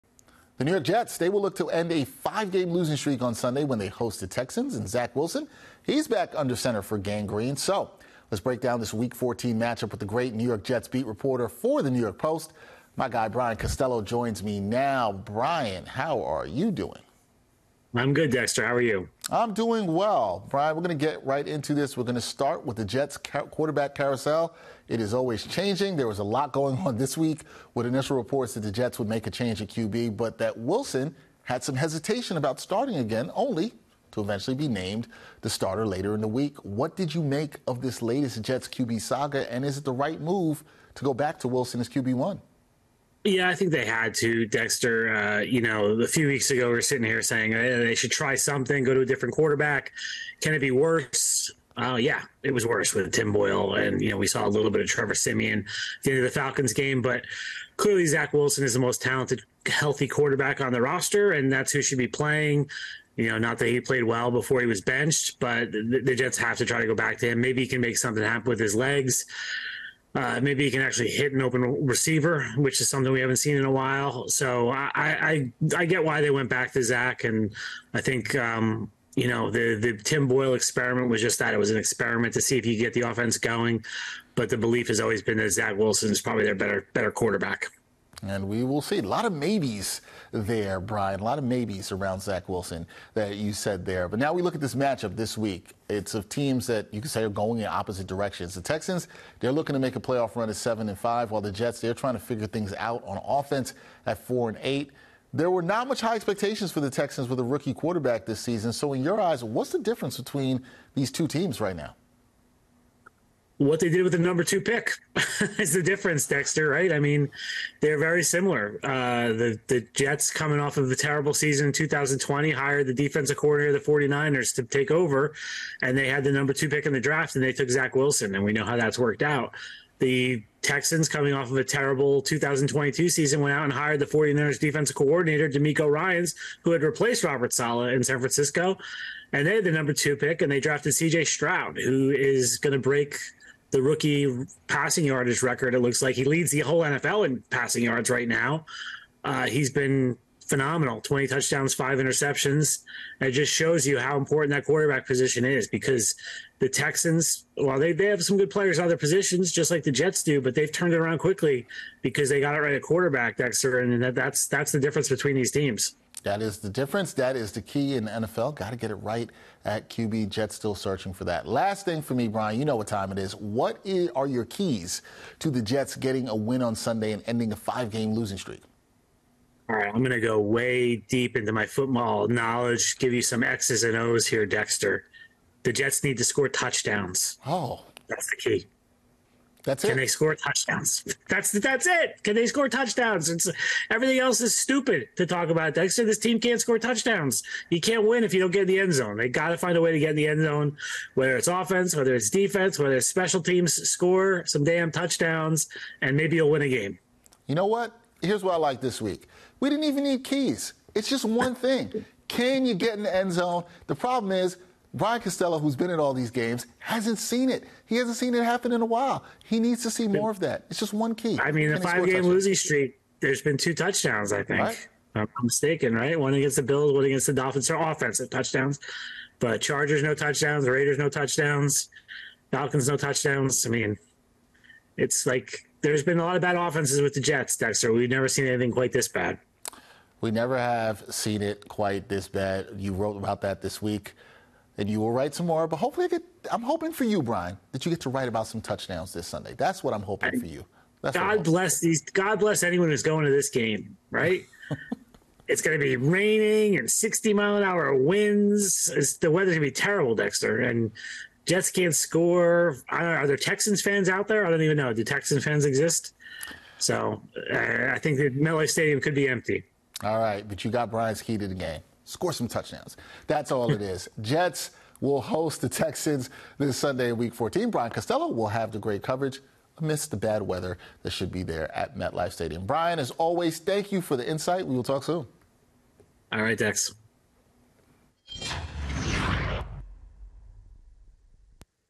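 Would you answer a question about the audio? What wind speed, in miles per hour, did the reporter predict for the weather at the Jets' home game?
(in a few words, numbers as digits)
60.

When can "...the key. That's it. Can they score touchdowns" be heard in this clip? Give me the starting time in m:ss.
3:08.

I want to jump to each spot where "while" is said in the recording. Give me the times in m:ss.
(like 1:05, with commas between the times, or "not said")
1:13, 1:41, 3:38.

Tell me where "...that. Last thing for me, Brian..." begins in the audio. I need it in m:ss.
2:51.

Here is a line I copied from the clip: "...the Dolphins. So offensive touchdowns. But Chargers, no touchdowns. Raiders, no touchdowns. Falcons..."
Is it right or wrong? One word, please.
right.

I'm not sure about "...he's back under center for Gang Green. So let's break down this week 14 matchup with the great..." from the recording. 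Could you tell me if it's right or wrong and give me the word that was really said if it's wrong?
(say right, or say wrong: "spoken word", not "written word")
right.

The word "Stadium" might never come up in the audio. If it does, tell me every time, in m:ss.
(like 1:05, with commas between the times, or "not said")
4:28, 4:42.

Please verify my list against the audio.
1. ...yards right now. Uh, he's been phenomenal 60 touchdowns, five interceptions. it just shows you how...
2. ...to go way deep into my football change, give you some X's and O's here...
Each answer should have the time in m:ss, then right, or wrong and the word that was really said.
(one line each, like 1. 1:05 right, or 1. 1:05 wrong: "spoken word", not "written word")
1. 2:27 wrong: "20", not "60"
2. 3:00 wrong: "knowledge", not "change".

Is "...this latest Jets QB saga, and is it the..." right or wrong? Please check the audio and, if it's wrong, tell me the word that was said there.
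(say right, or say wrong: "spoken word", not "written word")
right.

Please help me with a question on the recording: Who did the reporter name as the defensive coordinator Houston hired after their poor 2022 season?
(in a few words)
DeMeco Ryans.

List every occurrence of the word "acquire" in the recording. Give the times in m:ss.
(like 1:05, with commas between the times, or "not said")
not said.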